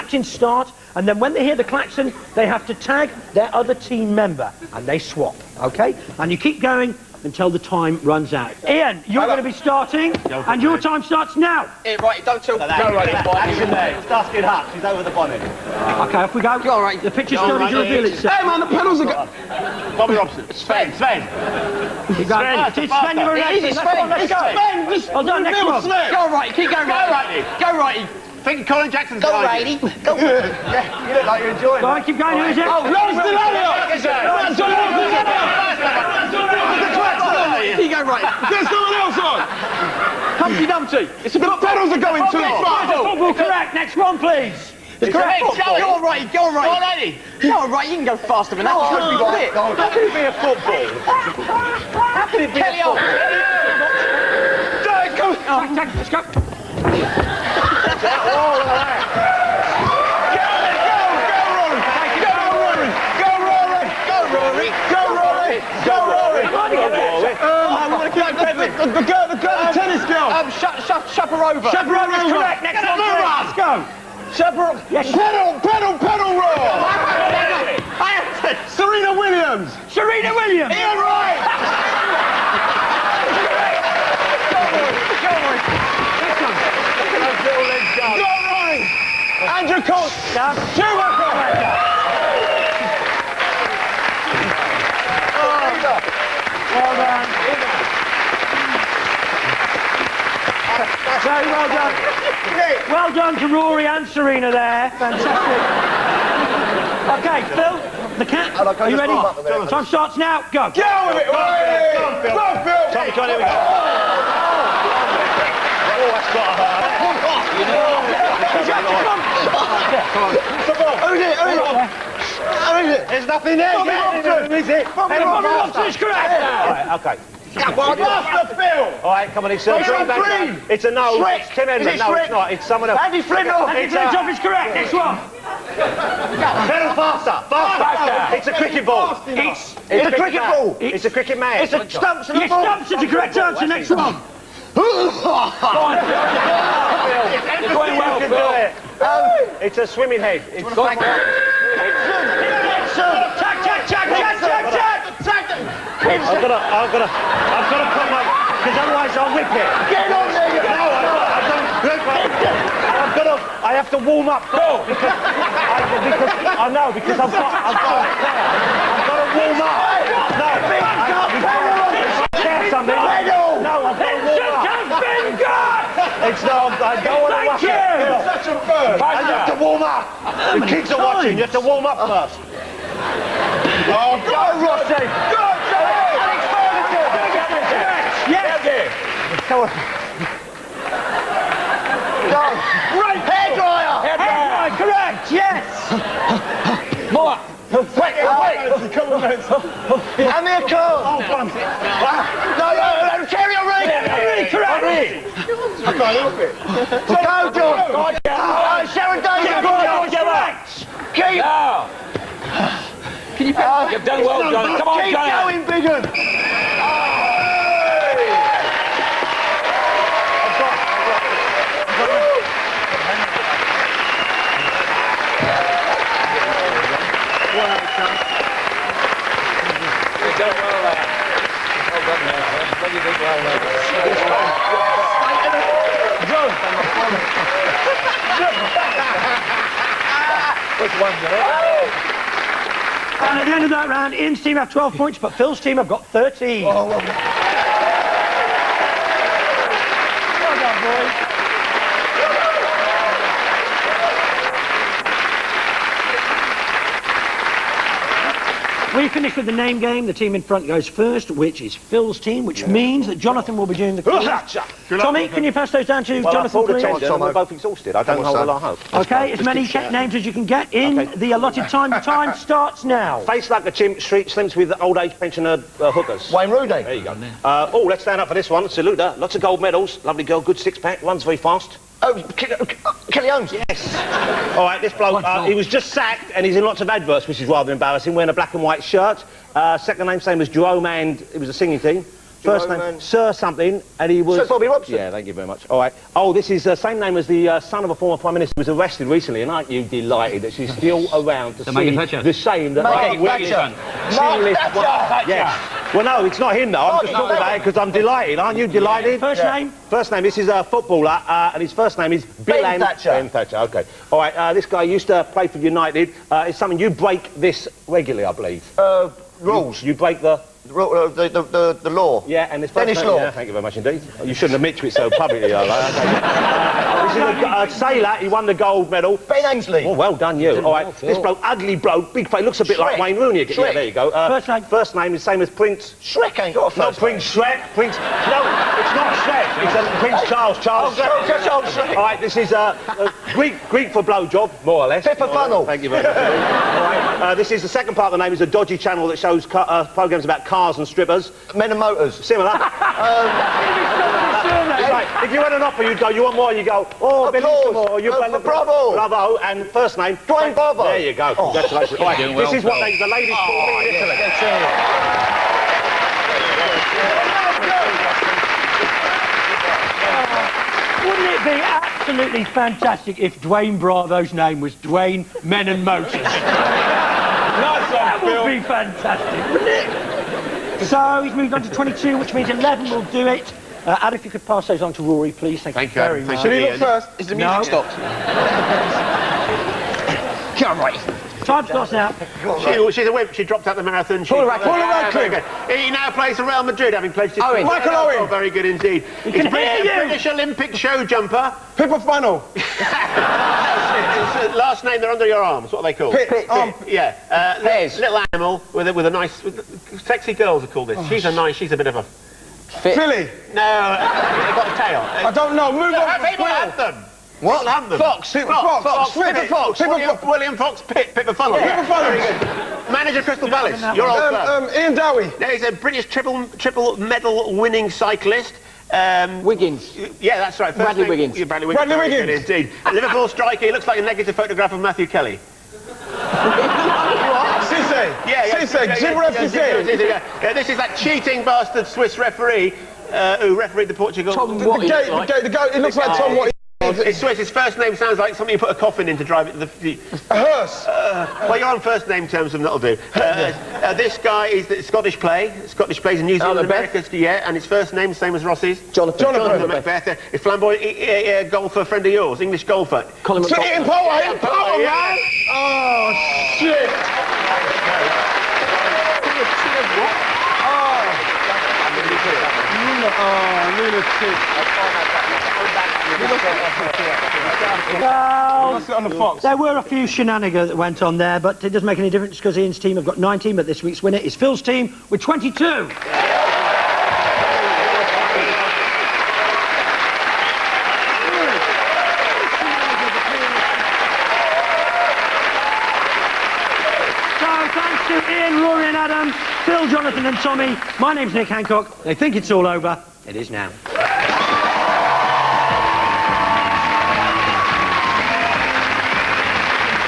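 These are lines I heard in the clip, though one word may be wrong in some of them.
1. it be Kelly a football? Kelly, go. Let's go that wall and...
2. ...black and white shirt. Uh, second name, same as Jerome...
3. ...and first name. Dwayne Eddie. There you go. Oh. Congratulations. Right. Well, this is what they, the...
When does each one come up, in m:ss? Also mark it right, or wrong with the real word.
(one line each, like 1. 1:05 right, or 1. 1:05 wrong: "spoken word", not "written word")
1. 0:52 right
2. 4:48 right
3. 5:59 wrong: "Bravo", not "Eddie".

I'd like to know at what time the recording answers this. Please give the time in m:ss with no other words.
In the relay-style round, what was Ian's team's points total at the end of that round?
4:04.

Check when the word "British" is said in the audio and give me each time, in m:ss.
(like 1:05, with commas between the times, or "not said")
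6:39, 7:05.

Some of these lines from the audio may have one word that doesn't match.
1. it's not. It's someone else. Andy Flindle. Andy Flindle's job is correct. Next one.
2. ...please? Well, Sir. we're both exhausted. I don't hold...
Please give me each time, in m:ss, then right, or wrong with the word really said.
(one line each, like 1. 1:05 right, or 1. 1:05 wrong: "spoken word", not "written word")
1. 2:12 right
2. 4:26 wrong: "Tommy", not "Sir".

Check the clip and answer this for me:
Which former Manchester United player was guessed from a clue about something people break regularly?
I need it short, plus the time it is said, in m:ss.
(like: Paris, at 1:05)
Denis Law, at 5:22.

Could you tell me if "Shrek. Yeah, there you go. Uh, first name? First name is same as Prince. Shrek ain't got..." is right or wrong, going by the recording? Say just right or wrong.
right.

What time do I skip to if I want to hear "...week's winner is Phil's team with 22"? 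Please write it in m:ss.
8:03.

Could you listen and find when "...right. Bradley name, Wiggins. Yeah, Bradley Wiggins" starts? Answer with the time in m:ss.
7:10.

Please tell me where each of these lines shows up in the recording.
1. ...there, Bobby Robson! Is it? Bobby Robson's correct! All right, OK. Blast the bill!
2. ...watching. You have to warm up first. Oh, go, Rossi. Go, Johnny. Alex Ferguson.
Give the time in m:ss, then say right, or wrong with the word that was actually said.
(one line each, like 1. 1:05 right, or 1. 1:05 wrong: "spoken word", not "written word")
1. 2:03 right
2. 3:00 right.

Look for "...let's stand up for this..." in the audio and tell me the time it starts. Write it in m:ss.
4:37.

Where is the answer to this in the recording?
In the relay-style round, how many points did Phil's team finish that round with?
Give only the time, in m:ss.
4:05.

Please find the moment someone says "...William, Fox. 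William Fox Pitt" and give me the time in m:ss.
6:59.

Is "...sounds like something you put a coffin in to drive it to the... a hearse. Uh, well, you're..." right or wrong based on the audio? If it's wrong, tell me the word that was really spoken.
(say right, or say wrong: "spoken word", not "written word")
right.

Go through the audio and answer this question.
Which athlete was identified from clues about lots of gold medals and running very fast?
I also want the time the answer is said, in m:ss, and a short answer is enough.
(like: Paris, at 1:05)
Kelly Holmes, at 4:43.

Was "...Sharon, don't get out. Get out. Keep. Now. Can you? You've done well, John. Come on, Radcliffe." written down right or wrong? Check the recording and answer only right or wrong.
wrong.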